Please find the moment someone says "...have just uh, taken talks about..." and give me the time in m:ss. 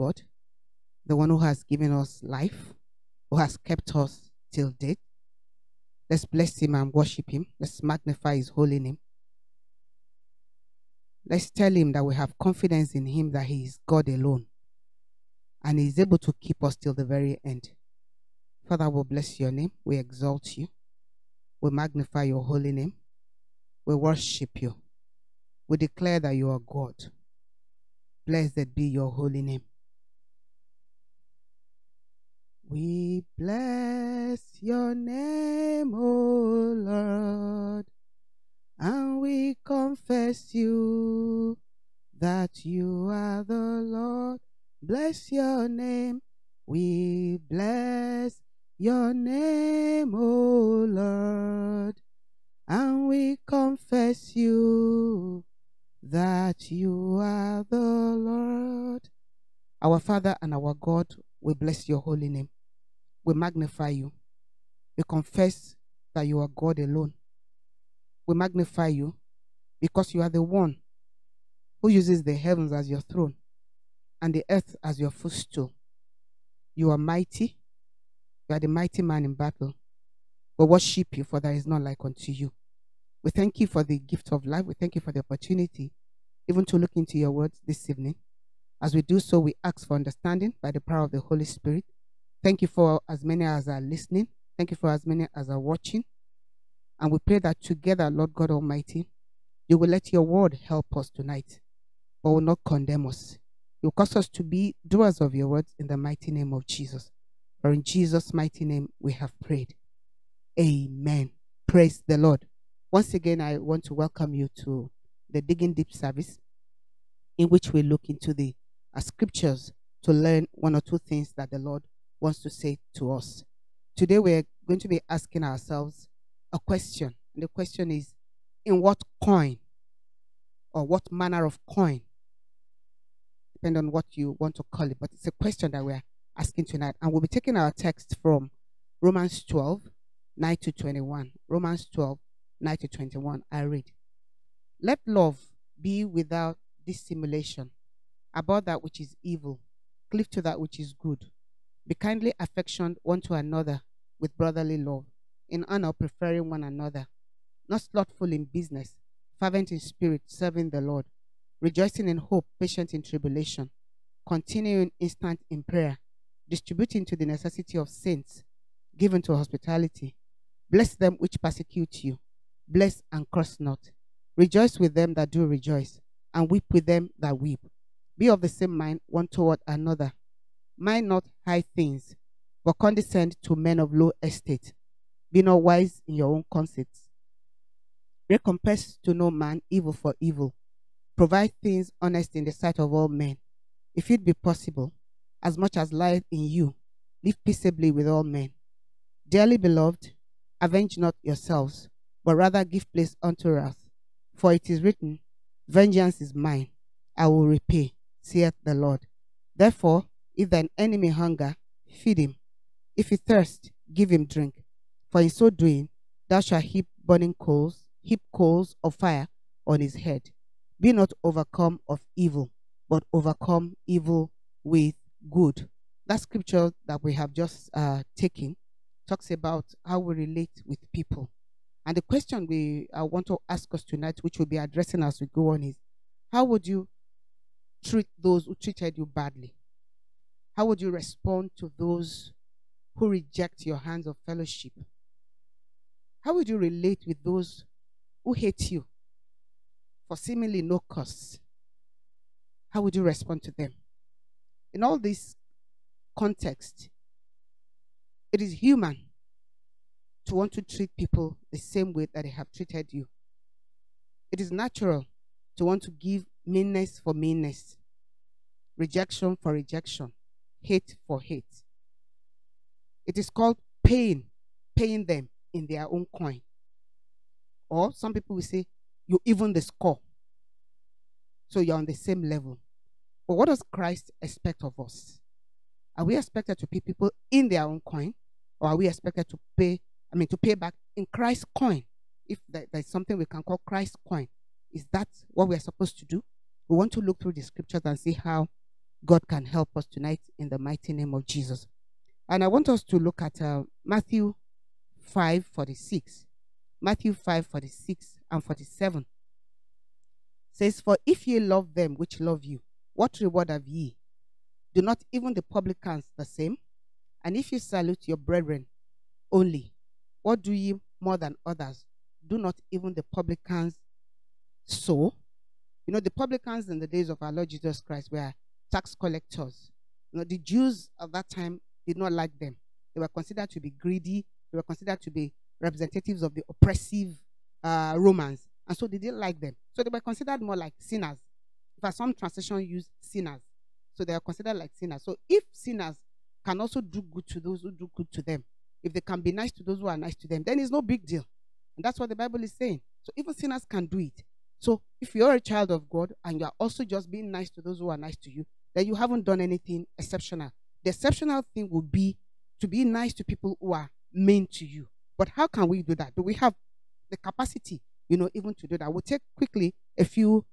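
3:47.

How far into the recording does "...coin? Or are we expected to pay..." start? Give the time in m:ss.
4:47.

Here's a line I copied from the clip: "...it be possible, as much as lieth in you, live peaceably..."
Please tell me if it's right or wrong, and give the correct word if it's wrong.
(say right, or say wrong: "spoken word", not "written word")
right.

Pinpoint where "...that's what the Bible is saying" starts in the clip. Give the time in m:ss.
5:51.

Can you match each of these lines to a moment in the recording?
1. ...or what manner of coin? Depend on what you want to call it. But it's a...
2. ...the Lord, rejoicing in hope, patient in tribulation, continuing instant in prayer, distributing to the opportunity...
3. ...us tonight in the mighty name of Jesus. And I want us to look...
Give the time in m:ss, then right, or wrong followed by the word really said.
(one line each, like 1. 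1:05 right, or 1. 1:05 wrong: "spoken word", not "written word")
1. 2:10 right
2. 2:40 wrong: "necessity", not "opportunity"
3. 4:59 right.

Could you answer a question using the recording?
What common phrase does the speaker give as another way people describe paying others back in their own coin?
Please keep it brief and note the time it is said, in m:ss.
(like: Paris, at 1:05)
even the score, at 4:39.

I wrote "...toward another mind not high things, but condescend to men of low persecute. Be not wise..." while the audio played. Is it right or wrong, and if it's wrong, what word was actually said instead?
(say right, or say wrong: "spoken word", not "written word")
wrong: "estate", not "persecute".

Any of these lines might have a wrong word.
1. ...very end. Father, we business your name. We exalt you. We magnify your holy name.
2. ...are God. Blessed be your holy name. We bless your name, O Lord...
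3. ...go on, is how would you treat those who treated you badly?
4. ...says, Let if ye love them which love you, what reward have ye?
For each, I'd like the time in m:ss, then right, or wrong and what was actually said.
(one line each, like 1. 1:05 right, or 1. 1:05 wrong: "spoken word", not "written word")
1. 0:17 wrong: "bless", not "business"
2. 0:26 right
3. 3:55 right
4. 5:10 wrong: "For", not "Let".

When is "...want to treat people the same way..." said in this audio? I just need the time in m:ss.
4:20.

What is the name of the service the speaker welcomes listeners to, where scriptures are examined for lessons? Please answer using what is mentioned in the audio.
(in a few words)
Digging Deep.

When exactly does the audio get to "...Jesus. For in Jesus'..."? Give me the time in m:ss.
1:46.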